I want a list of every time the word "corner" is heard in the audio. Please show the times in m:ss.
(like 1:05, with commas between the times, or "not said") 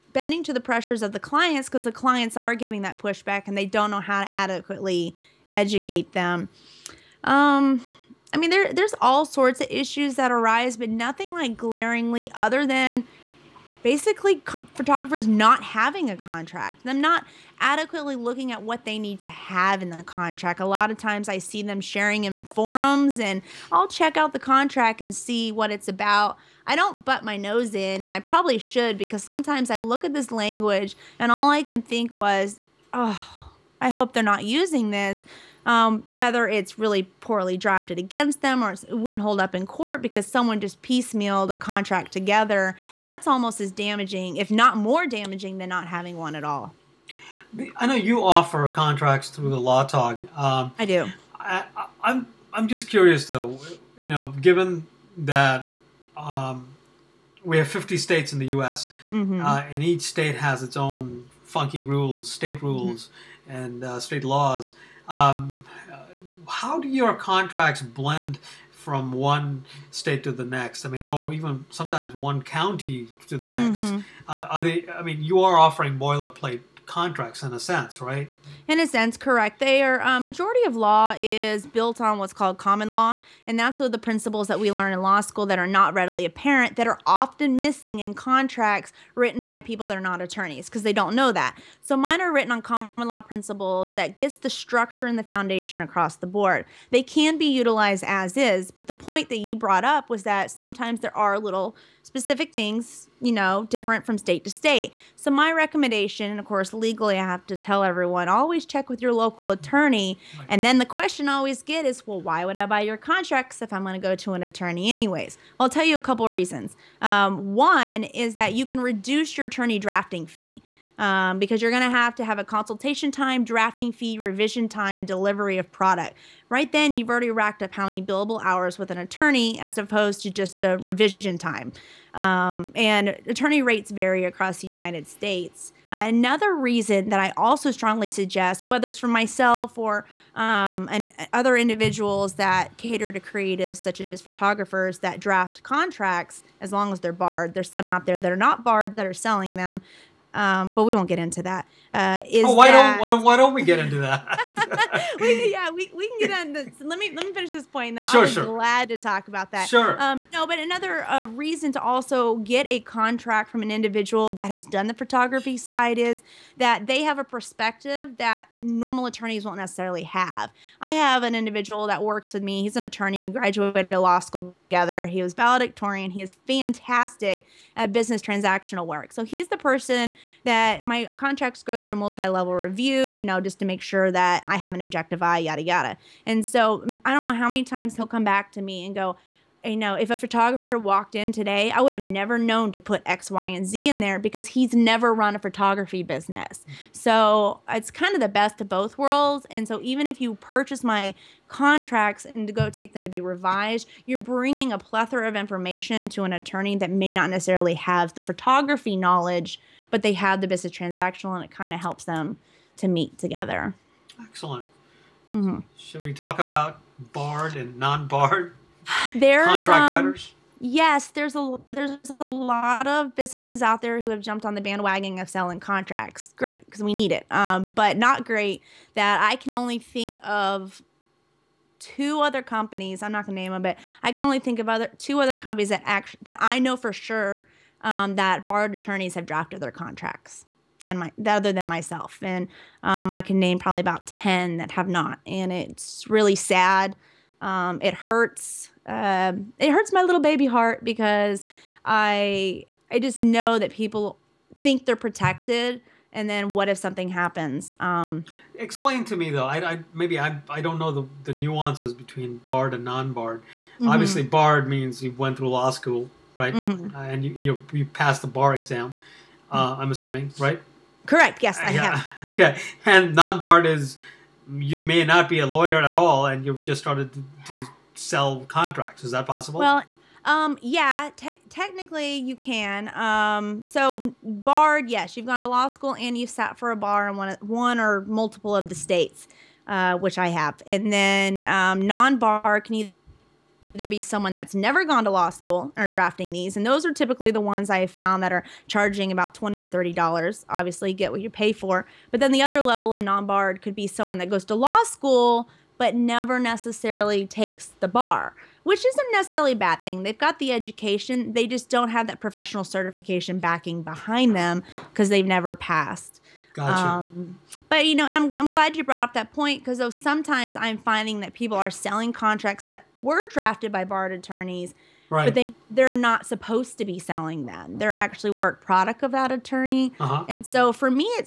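not said.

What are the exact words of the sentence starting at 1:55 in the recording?
I'll tell you a couple of reasons.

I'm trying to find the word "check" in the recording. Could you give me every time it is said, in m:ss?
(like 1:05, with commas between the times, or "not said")
0:23, 1:48.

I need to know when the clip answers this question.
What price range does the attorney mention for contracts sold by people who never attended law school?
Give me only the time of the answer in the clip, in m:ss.
4:59.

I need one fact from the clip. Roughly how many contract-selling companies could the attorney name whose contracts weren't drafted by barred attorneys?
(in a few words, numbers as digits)
About 10.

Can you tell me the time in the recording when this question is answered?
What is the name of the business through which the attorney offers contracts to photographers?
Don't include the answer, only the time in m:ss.
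0:49.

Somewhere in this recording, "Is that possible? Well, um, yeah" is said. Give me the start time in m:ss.
4:39.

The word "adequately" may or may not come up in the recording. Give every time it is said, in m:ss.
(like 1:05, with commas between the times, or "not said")
0:04, 0:17.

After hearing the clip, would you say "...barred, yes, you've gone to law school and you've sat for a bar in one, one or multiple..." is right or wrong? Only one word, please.
right.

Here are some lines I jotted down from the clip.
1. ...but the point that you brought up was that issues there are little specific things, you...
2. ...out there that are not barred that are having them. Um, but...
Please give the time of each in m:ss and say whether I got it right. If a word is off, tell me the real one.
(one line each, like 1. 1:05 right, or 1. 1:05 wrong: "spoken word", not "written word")
1. 1:38 wrong: "sometimes", not "issues"
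2. 2:27 wrong: "selling", not "having".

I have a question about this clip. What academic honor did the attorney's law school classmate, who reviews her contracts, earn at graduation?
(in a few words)
Valedictorian.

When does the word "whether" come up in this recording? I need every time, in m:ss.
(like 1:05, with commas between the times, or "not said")
0:36, 2:18.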